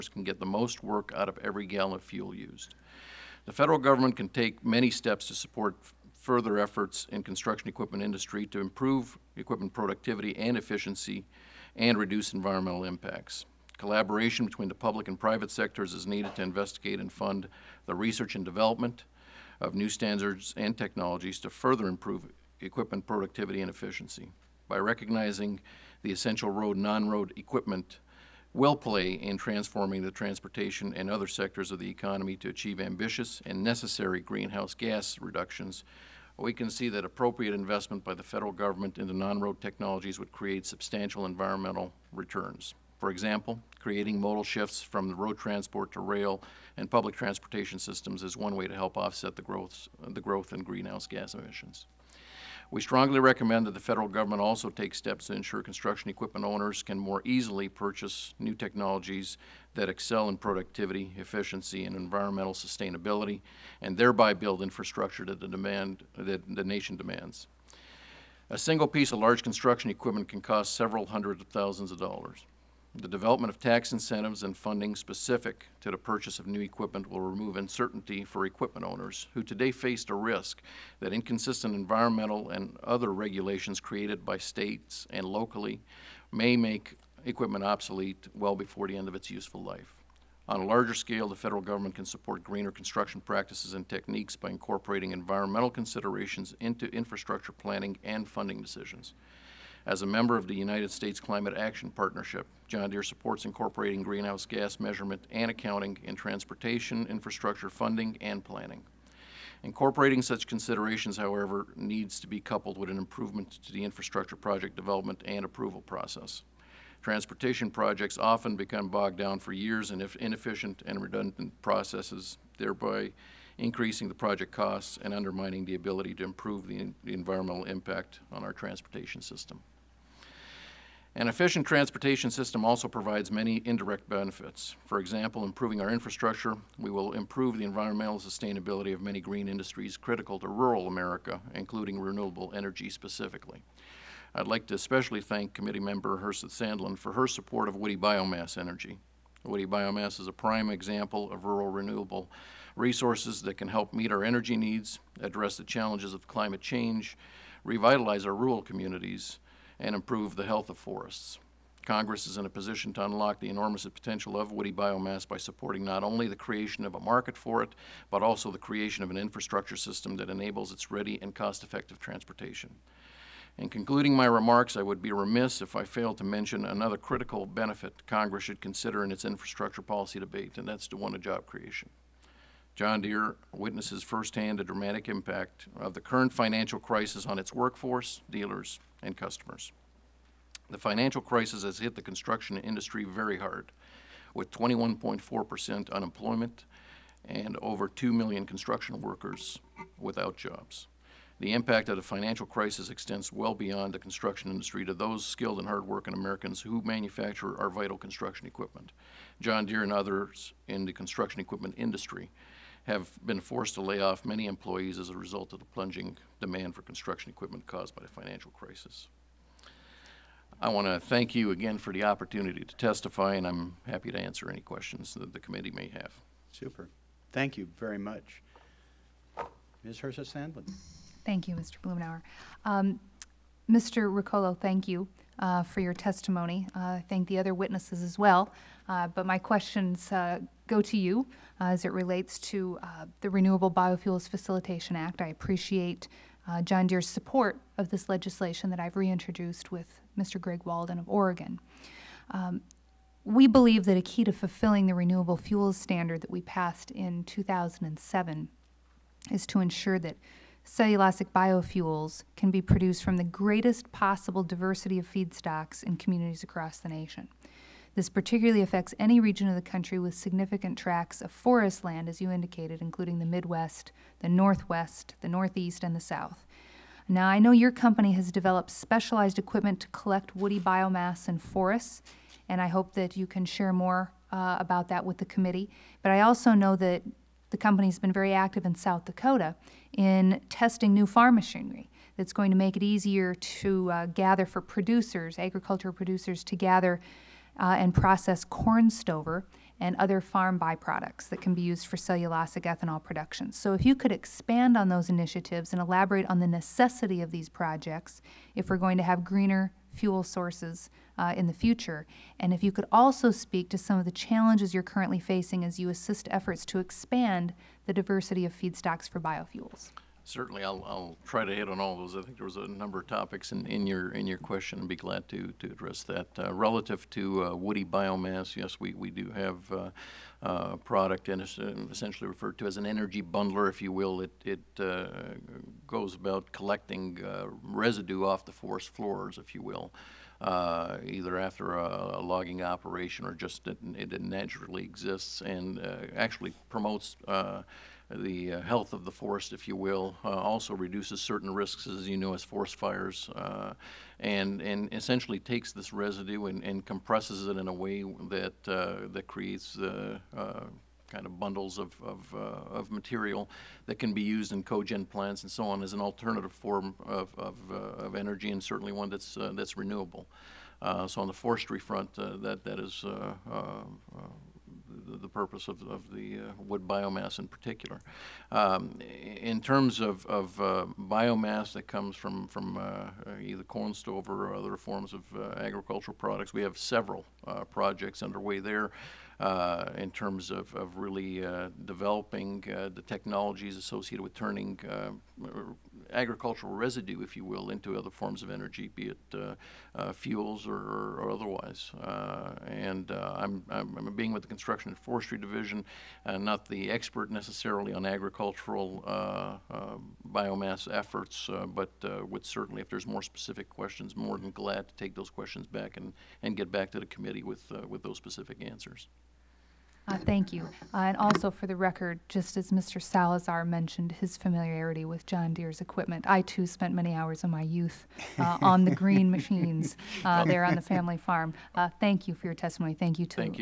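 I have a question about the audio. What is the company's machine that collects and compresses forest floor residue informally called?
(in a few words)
energy bundler.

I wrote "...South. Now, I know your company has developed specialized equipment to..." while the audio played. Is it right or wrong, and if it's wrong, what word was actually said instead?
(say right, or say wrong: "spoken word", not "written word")
right.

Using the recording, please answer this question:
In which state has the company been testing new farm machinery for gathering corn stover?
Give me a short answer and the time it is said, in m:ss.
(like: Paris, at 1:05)
South Dakota, at 4:48.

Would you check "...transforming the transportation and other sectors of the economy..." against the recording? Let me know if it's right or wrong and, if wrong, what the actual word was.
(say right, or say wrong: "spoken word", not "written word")
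right.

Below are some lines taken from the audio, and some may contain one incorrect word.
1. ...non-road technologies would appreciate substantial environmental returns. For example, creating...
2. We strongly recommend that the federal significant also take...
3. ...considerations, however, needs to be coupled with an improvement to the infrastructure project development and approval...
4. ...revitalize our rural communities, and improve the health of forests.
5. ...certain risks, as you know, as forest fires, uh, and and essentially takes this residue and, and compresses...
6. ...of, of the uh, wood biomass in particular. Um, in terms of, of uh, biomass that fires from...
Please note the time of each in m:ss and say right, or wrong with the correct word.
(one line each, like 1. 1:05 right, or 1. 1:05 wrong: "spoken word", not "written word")
1. 0:39 wrong: "create", not "appreciate"
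2. 0:52 wrong: "government", not "significant"
3. 1:50 right
4. 2:37 right
5. 5:51 right
6. 6:15 wrong: "comes", not "fires".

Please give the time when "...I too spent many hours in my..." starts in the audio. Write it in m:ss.
7:06.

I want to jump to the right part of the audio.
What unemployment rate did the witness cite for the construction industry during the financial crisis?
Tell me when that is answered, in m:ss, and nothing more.
3:14.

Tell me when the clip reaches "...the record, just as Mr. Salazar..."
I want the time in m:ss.
7:01.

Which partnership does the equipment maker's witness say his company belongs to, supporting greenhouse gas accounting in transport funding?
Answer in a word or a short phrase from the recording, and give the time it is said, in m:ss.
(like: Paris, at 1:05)
United States Climate Action Partnership, at 1:40.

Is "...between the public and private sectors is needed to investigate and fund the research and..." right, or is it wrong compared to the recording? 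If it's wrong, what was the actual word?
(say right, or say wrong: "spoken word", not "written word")
right.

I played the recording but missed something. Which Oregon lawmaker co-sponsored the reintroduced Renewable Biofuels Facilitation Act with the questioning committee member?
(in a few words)
Greg Walden.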